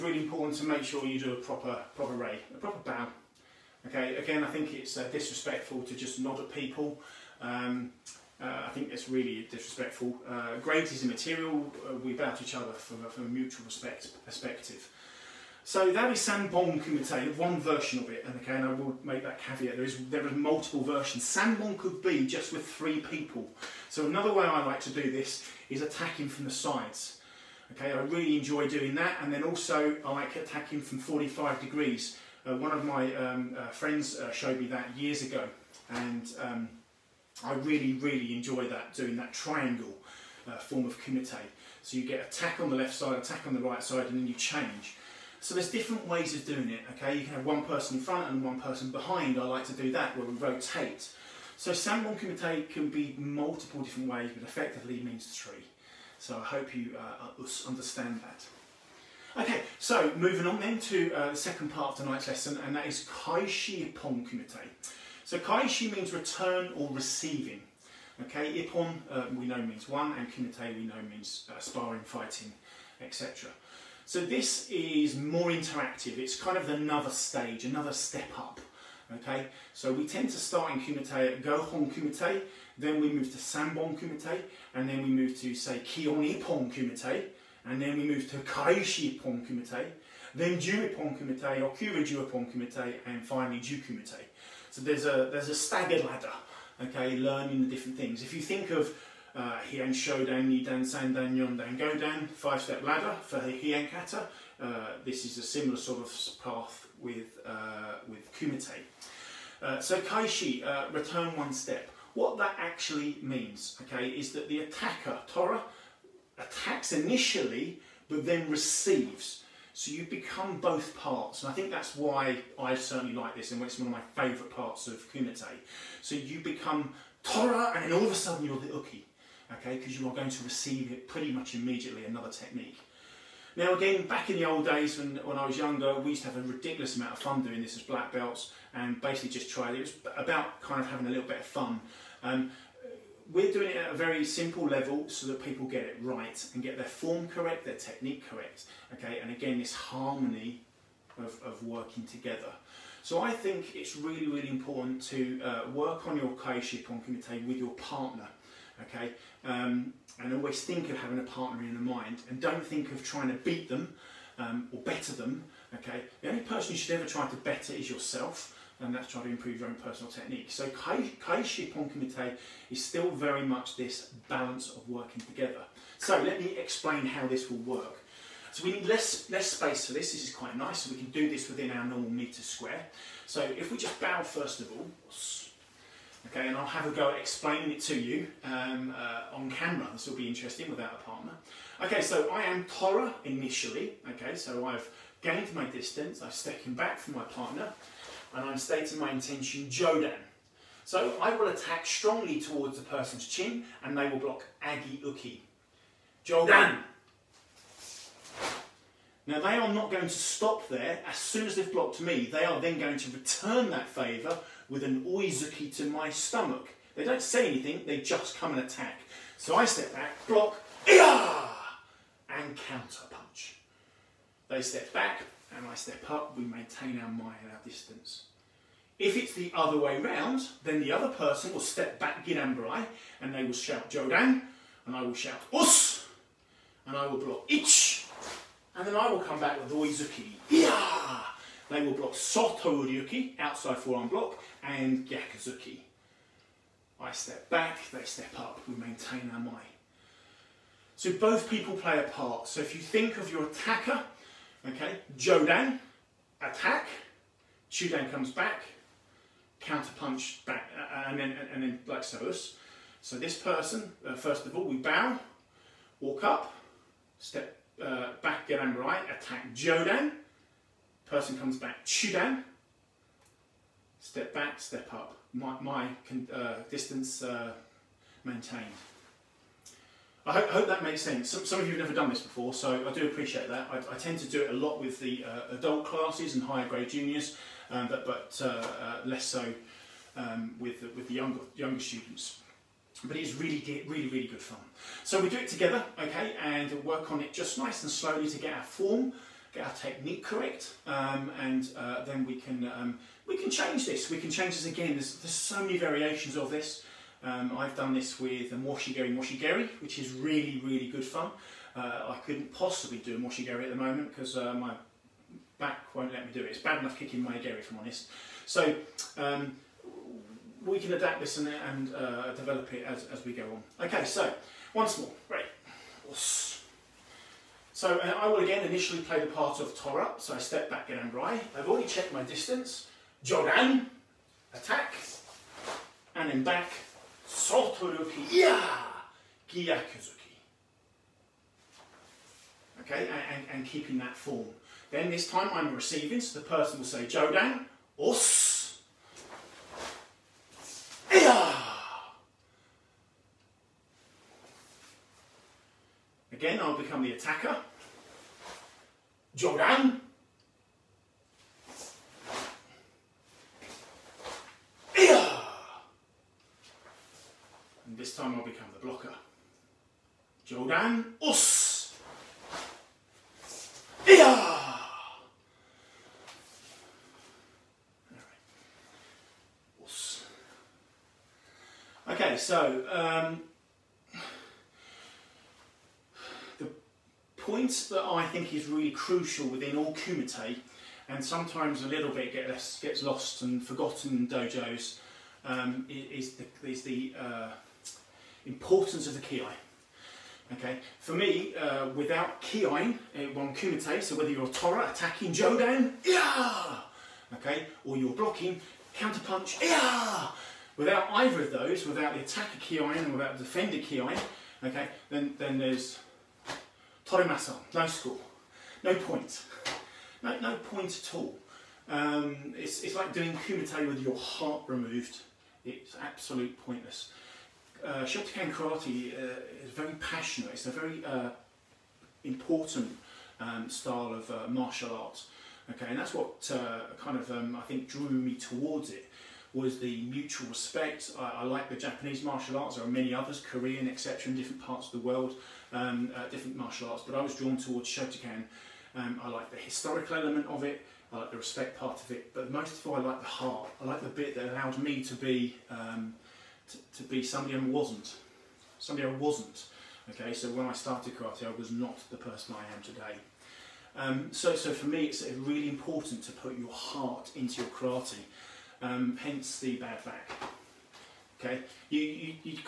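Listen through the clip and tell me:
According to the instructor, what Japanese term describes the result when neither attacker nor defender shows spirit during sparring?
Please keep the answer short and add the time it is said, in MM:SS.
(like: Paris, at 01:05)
Torimasen, at 06:57.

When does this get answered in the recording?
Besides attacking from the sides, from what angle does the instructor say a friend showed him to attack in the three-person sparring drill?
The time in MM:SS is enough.
00:30.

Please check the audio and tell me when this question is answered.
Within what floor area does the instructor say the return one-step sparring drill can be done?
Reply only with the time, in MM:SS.
03:02.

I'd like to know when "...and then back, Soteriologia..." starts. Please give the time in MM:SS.
05:36.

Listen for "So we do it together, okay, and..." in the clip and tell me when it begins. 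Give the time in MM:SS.
04:55.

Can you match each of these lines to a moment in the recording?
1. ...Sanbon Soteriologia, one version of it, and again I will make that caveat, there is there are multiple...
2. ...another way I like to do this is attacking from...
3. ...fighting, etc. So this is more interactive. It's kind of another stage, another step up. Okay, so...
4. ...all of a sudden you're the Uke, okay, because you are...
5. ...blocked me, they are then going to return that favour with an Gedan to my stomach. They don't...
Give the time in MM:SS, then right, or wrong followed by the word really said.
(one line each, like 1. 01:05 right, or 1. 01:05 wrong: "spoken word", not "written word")
1. 00:16 wrong: "Kumite", not "Soteriologia"
2. 00:24 right
3. 01:12 right
4. 02:07 right
5. 03:31 wrong: "Oizuki", not "Gedan".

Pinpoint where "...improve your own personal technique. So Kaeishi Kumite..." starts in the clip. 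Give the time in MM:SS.
02:49.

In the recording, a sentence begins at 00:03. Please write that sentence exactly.
Okay, again, I think it's uh, disrespectful to just nod at people.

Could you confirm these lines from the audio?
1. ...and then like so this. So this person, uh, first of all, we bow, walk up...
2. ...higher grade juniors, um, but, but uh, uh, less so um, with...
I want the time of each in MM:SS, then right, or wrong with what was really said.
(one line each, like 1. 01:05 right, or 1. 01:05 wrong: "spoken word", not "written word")
1. 04:21 right
2. 04:46 right.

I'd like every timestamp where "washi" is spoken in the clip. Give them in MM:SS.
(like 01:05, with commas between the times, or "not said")
05:08, 05:13.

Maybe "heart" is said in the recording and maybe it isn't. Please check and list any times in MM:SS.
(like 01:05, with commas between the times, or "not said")
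07:04, 07:33, 07:46.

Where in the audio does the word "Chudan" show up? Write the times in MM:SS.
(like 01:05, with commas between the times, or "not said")
04:17, 04:31.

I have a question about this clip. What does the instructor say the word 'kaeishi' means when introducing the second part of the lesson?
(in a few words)
Return or receiving.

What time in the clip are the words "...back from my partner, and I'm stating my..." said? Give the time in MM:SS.
03:16.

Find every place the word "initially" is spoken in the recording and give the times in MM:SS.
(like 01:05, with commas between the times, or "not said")
01:56, 03:13, 05:28.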